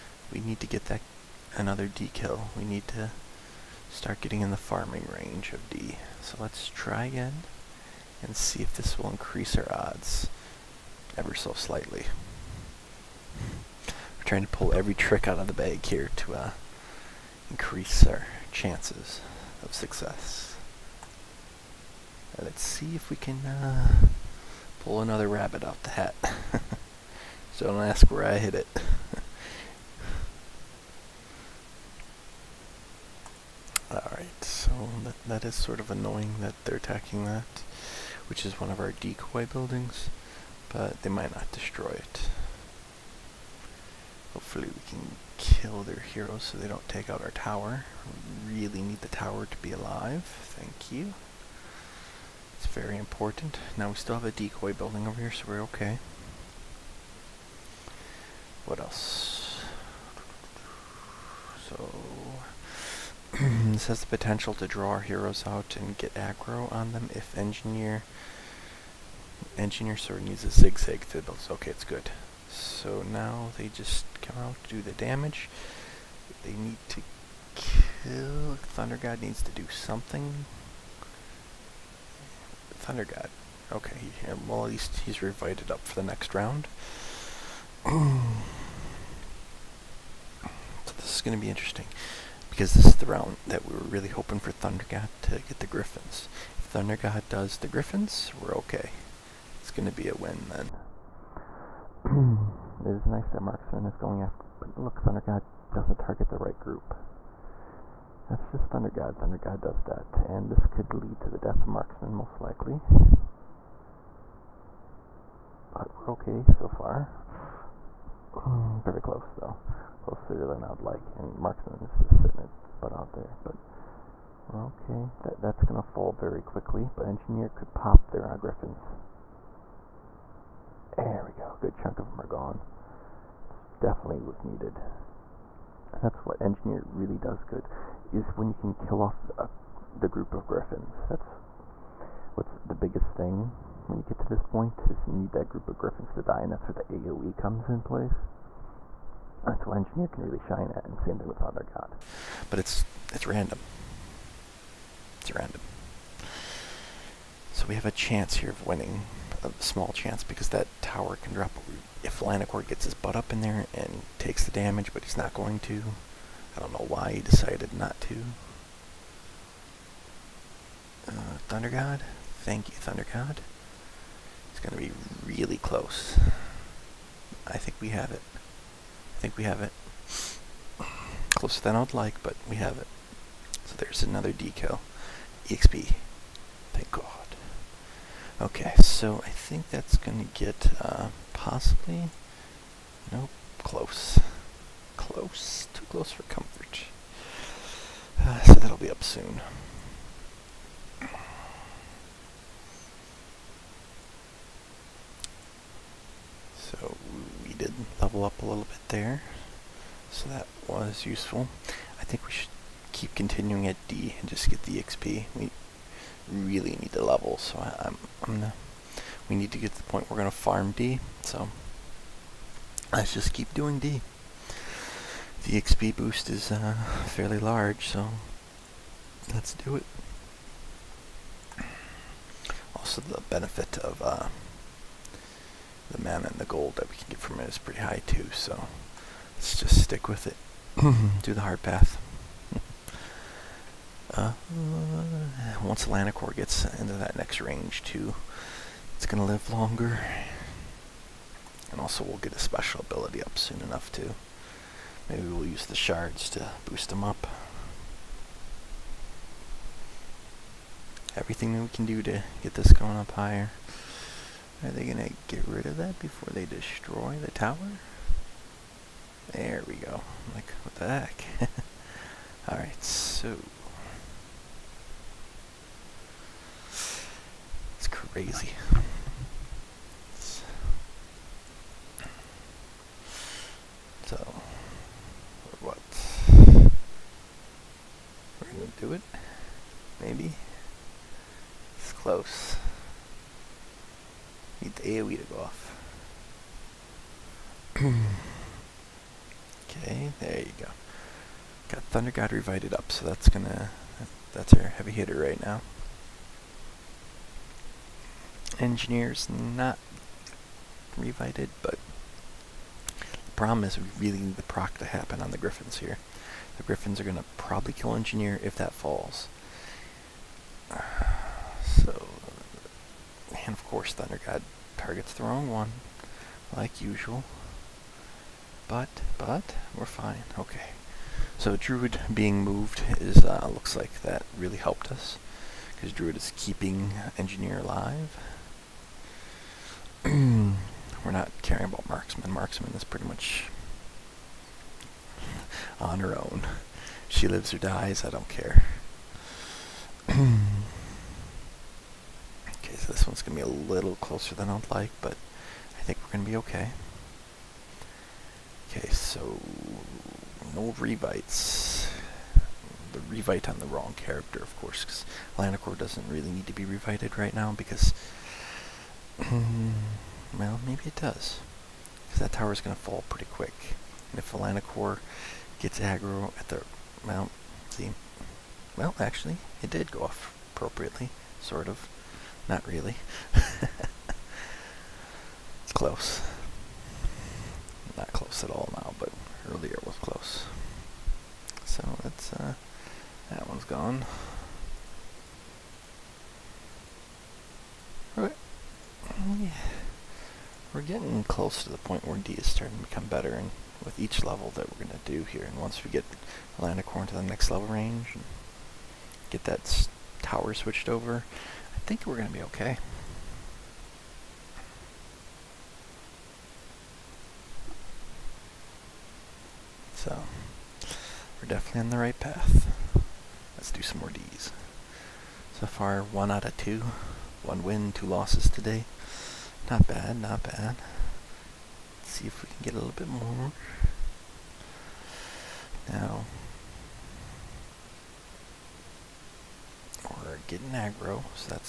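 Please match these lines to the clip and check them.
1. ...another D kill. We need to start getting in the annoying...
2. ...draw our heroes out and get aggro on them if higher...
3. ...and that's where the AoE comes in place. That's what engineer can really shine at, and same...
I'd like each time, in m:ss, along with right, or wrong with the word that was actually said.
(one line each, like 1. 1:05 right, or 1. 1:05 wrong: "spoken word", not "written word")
1. 0:01 wrong: "farming", not "annoying"
2. 1:04 wrong: "engineer", not "higher"
3. 2:26 right.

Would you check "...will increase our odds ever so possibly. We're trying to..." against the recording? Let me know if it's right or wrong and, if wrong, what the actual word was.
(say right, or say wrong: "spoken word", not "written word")
wrong: "slightly", not "possibly".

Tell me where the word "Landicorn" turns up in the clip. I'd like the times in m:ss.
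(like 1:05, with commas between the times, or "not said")
6:46.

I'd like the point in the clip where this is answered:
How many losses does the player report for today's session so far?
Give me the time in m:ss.
7:07.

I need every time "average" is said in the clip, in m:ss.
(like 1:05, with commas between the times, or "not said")
not said.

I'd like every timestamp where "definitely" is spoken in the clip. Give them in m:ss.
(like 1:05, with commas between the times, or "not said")
2:13, 7:01.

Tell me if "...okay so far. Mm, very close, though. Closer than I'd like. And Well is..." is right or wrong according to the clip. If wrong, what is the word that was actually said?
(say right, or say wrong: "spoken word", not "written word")
wrong: "Marksman", not "Well".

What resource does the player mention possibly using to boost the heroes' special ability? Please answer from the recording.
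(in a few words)
Shards.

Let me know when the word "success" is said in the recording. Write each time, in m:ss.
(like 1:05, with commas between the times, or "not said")
0:19.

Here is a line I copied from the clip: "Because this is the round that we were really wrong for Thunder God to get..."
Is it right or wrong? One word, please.
wrong.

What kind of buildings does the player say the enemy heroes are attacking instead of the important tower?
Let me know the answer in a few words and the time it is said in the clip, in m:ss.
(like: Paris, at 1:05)
Decoy buildings, at 0:38.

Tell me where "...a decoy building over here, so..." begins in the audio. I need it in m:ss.
0:54.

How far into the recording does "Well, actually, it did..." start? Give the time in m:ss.
6:18.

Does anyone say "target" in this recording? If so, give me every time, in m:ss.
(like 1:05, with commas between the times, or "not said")
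1:45, 5:24.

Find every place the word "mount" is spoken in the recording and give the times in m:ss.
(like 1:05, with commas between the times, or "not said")
6:17.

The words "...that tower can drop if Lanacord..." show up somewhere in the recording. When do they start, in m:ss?
2:40.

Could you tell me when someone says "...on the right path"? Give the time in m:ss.
7:01.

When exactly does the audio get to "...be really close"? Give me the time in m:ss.
2:54.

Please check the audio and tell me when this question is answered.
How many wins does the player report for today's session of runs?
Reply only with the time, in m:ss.
7:07.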